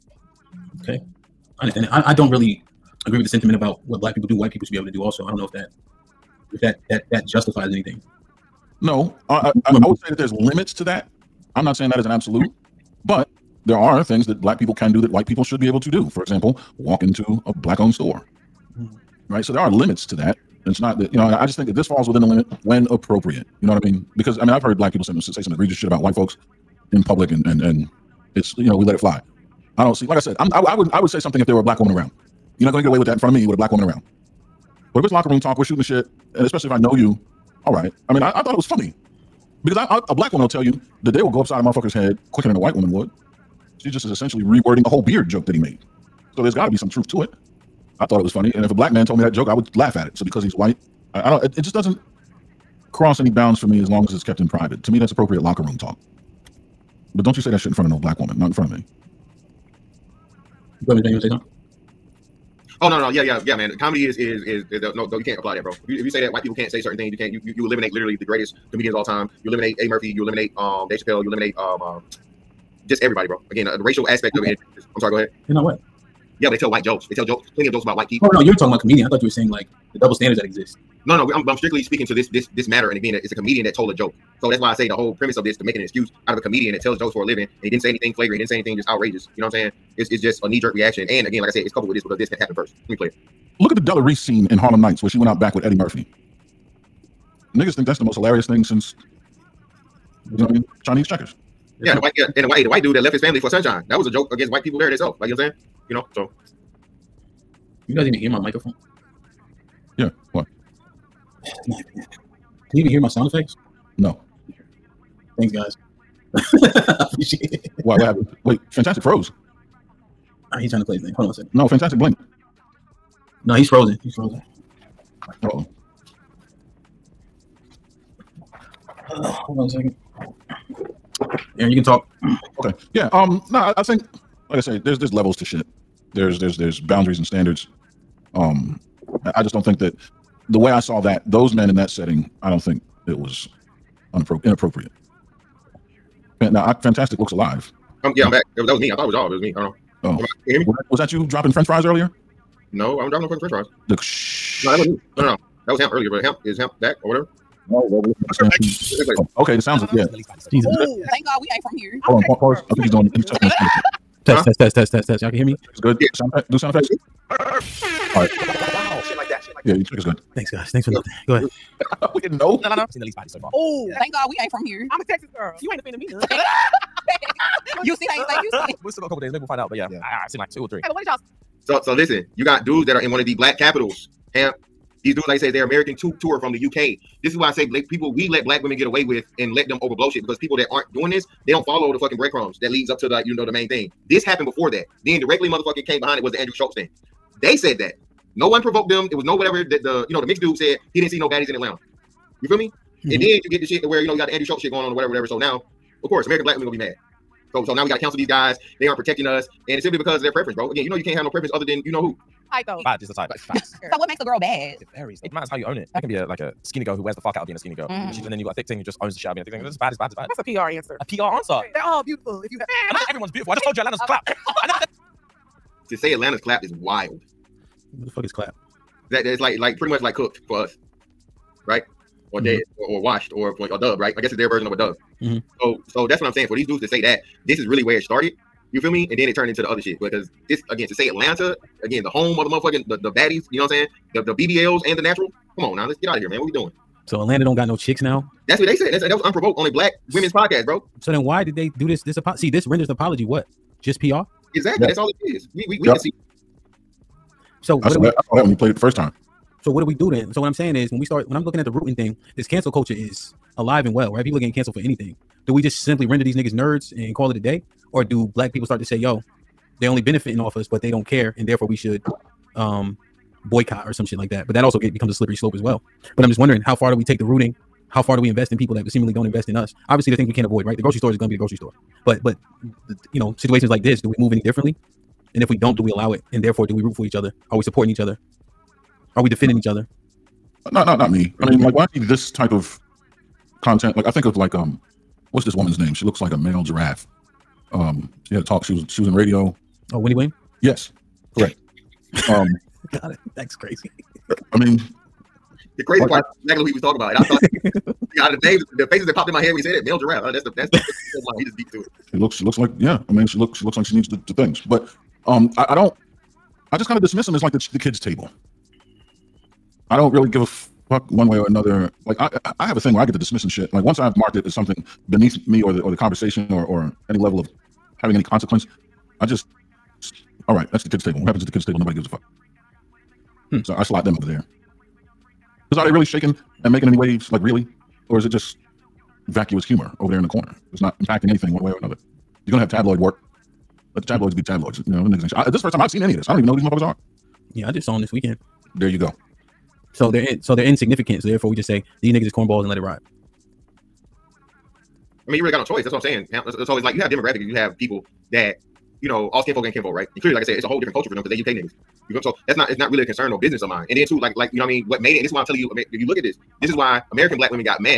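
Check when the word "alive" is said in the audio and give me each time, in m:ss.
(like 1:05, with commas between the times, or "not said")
2:27, 4:23.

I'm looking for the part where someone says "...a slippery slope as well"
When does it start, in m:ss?
4:35.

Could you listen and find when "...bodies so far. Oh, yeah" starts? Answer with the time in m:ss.
2:53.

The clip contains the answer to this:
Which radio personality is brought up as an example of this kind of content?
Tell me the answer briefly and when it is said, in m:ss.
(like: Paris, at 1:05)
Winnie Wayne, at 4:59.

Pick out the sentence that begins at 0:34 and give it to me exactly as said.
But if it's locker room talk, we're shooting the shit, and especially if I know you all right.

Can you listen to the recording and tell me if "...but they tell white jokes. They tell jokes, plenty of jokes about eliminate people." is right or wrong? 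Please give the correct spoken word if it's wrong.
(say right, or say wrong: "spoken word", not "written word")
wrong: "white", not "eliminate".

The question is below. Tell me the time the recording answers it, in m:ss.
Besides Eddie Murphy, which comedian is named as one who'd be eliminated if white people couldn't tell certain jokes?
1:10.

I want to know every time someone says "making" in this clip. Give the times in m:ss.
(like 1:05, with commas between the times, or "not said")
1:25, 5:36.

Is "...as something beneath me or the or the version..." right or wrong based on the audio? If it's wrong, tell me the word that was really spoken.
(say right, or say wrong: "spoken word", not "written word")
wrong: "conversation", not "version".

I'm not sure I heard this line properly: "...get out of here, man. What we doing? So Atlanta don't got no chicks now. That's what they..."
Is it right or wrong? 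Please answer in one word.
right.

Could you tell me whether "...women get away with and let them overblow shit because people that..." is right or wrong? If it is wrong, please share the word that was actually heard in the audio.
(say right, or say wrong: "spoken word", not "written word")
right.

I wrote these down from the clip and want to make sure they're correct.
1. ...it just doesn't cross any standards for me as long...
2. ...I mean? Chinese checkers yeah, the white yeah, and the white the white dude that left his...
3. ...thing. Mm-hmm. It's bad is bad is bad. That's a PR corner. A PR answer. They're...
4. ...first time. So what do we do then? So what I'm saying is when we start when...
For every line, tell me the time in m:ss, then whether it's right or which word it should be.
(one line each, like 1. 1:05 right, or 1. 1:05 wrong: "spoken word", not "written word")
1. 0:51 wrong: "bounds", not "standards"
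2. 1:40 right
3. 3:39 wrong: "answer", not "corner"
4. 4:18 right.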